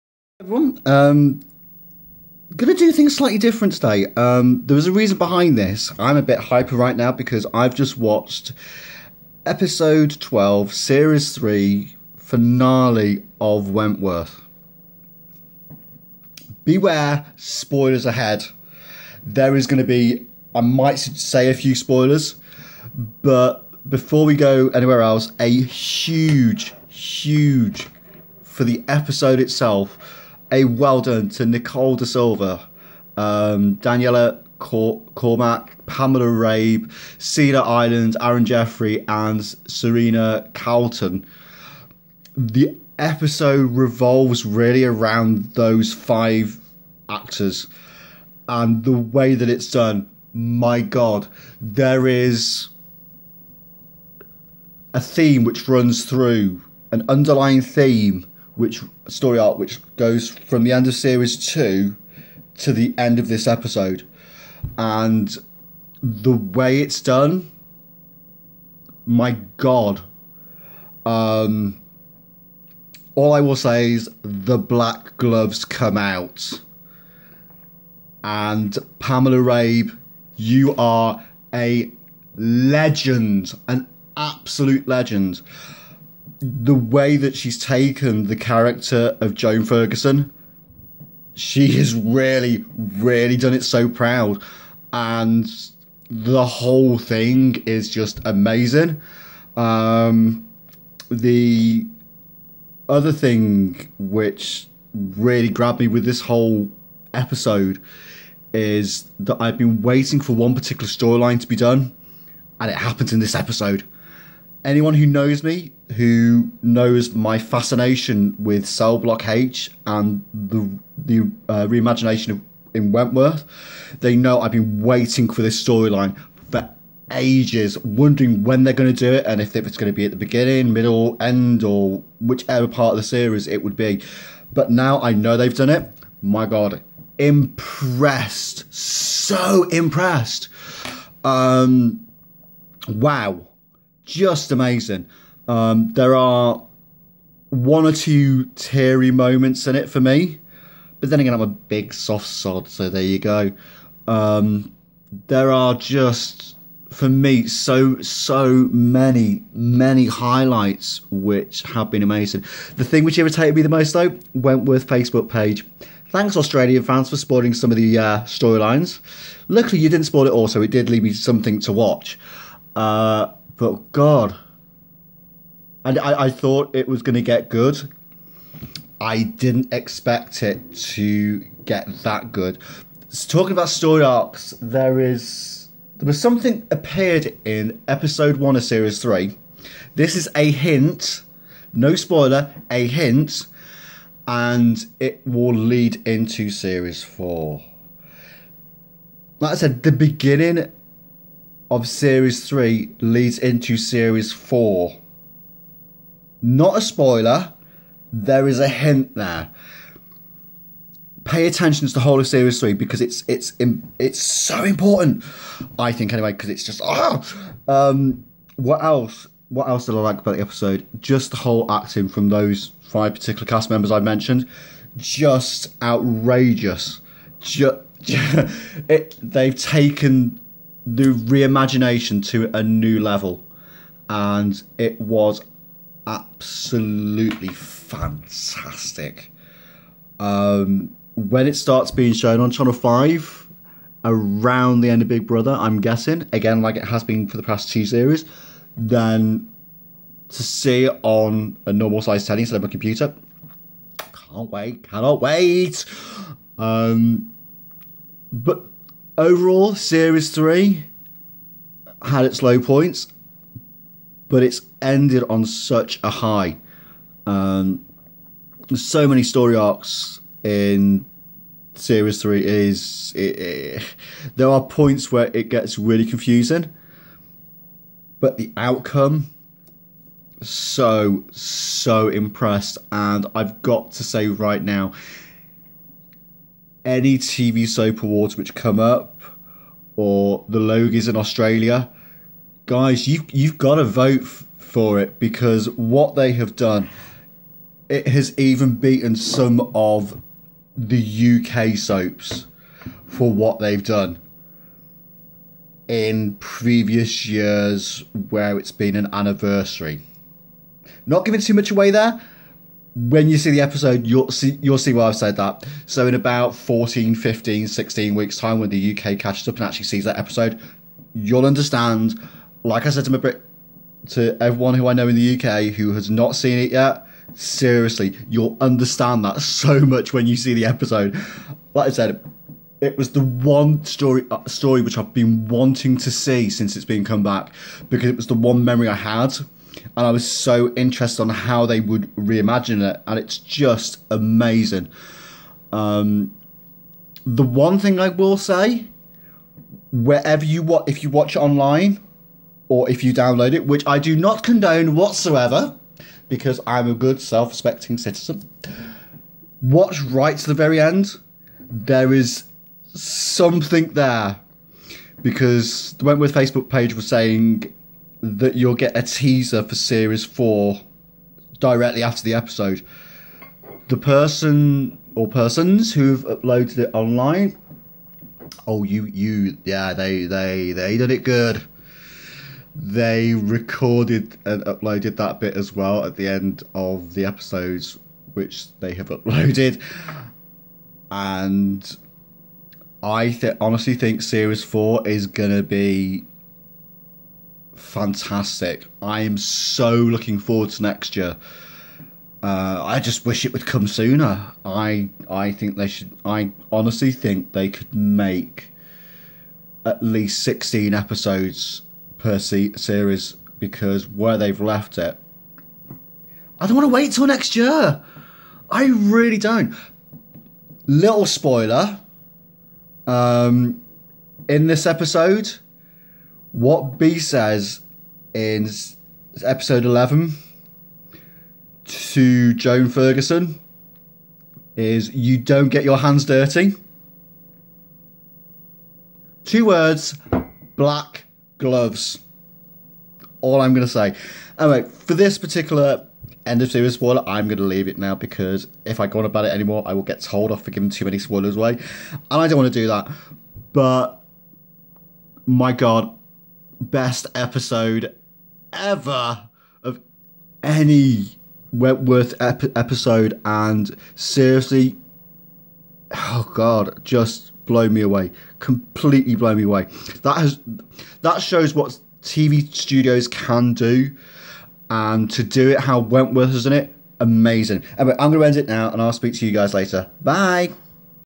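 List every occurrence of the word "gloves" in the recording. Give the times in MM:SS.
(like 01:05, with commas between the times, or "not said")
01:15, 07:21.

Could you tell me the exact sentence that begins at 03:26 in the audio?
Not a spoiler, there is a hint there.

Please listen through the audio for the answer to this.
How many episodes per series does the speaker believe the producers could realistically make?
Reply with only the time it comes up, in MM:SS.
06:50.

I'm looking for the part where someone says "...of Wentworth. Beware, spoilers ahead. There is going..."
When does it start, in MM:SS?
00:13.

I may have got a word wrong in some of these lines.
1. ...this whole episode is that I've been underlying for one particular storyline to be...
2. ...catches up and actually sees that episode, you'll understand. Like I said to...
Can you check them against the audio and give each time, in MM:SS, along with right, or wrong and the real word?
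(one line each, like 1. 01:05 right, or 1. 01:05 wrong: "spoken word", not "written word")
1. 01:46 wrong: "waiting", not "underlying"
2. 05:19 right.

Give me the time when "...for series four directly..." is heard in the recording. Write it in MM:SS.
06:09.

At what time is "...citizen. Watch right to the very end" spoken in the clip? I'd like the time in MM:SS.
05:57.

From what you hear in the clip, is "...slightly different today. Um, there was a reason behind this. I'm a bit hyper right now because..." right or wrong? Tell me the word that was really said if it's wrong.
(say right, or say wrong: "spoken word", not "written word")
right.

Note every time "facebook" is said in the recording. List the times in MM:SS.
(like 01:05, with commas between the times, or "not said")
02:44, 06:06.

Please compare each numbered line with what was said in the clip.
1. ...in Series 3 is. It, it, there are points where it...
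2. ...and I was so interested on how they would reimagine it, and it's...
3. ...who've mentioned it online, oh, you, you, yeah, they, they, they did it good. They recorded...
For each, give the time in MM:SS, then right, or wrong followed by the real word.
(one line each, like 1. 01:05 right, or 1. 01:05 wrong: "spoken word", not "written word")
1. 04:30 right
2. 05:39 right
3. 06:15 wrong: "uploaded", not "mentioned".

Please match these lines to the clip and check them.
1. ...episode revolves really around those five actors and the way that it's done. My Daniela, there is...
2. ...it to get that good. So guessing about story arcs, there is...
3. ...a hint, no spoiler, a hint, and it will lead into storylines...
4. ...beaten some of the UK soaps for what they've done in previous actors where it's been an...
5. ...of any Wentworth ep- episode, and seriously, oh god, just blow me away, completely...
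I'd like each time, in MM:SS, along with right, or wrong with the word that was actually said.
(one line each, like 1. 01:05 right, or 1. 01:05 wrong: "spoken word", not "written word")
1. 00:42 wrong: "God", not "Daniela"
2. 03:00 wrong: "talking", not "guessing"
3. 03:10 wrong: "series", not "storylines"
4. 04:58 wrong: "years", not "actors"
5. 07:39 right.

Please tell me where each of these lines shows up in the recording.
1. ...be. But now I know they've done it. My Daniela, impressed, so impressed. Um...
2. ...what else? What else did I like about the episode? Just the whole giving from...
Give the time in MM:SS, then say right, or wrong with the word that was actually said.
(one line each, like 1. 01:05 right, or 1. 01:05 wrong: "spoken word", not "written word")
1. 02:13 wrong: "God", not "Daniela"
2. 03:38 wrong: "acting", not "giving".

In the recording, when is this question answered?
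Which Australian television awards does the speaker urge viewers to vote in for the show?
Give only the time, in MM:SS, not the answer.
04:50.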